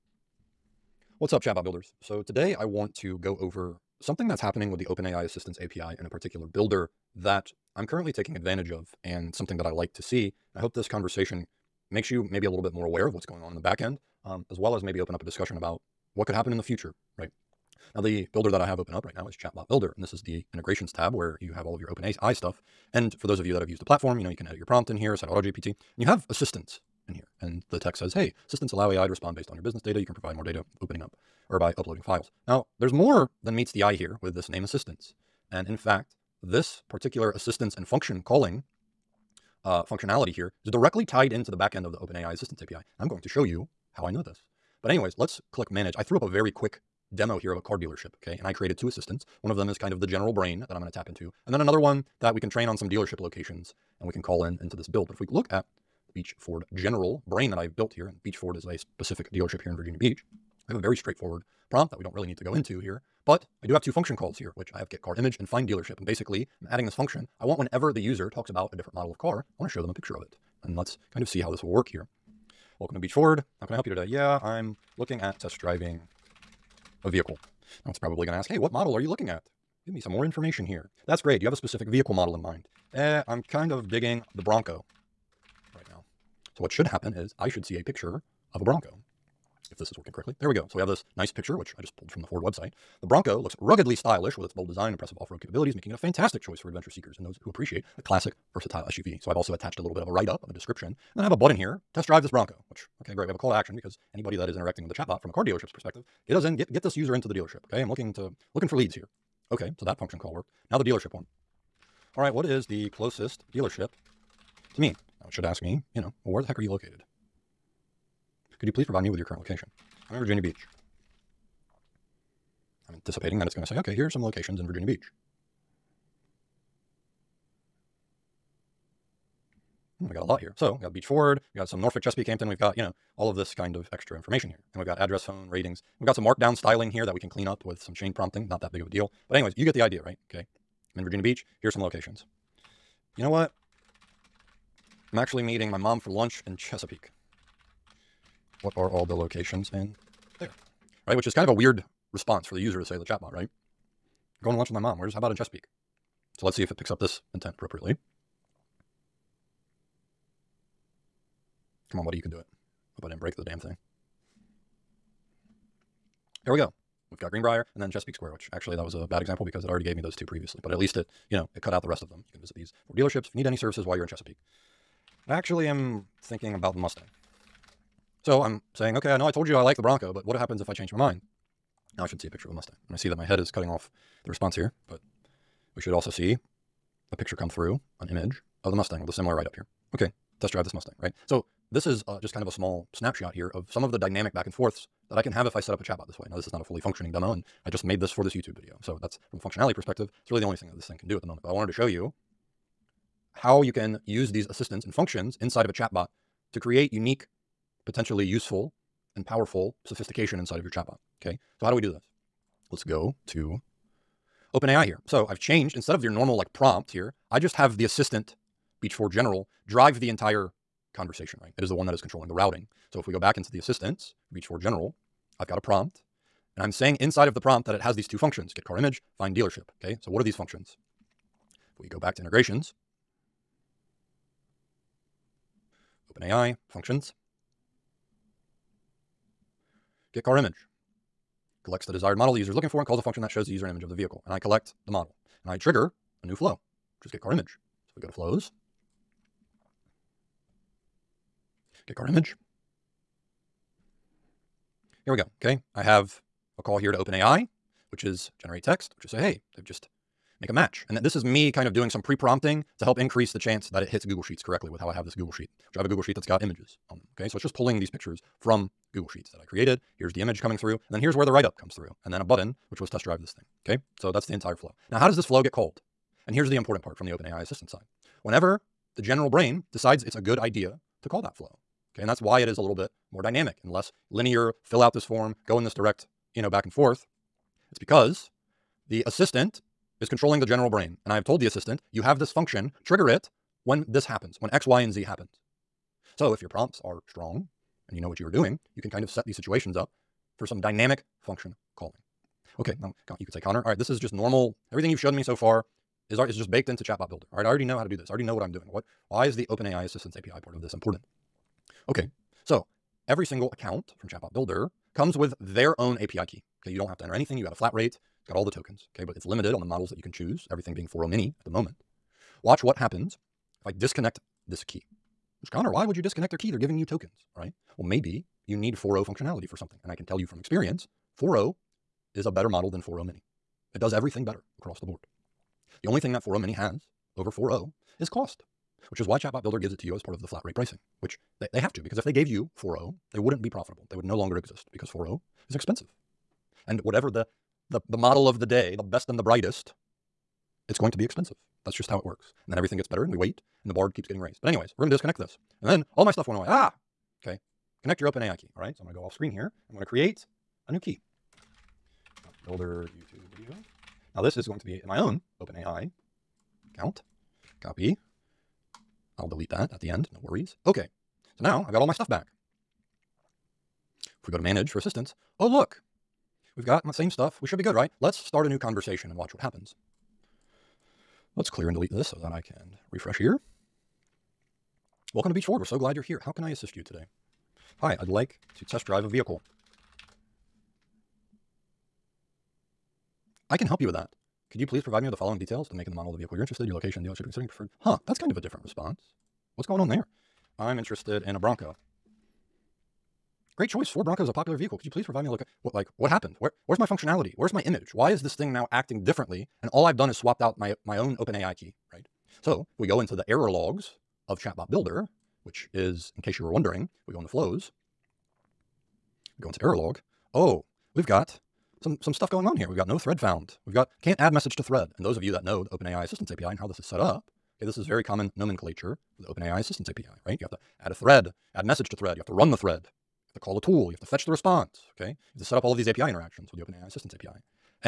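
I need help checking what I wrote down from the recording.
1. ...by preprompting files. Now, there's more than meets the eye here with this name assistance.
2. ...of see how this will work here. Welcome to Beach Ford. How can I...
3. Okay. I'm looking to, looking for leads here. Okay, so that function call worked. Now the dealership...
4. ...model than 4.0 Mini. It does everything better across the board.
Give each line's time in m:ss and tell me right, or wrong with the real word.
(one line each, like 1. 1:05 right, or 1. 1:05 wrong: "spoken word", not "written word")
1. 0:31 wrong: "uploading", not "preprompting"
2. 1:11 right
3. 1:47 right
4. 5:32 right.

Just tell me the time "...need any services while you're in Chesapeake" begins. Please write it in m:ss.
2:53.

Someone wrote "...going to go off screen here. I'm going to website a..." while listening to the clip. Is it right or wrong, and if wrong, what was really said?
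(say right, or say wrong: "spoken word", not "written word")
wrong: "create", not "website".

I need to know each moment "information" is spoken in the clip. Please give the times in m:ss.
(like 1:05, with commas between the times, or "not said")
1:20, 2:14.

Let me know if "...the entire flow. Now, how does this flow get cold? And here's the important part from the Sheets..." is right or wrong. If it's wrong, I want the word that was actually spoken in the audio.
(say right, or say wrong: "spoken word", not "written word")
wrong: "OpenAI", not "Sheets".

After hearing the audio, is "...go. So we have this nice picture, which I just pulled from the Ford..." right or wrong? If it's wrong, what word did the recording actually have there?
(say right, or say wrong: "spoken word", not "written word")
right.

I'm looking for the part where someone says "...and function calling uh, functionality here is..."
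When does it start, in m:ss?
0:37.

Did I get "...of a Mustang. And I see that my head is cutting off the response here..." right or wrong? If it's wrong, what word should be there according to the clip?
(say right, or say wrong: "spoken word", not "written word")
right.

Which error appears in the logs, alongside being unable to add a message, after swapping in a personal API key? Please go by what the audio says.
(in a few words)
no thread found.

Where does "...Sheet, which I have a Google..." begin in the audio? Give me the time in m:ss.
4:25.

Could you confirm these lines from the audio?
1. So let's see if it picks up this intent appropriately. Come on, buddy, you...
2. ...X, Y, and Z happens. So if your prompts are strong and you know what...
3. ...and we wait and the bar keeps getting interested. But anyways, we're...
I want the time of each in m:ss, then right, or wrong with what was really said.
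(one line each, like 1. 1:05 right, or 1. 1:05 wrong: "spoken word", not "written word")
1. 2:36 right
2. 4:54 right
3. 5:53 wrong: "raised", not "interested".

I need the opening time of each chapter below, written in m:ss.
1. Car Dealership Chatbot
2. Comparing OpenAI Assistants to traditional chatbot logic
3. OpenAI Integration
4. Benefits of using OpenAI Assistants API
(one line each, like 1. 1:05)
1. 1:22
2. 4:35
3. 3:10
4. 6:45.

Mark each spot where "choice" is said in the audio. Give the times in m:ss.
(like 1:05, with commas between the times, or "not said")
1:36, 6:43.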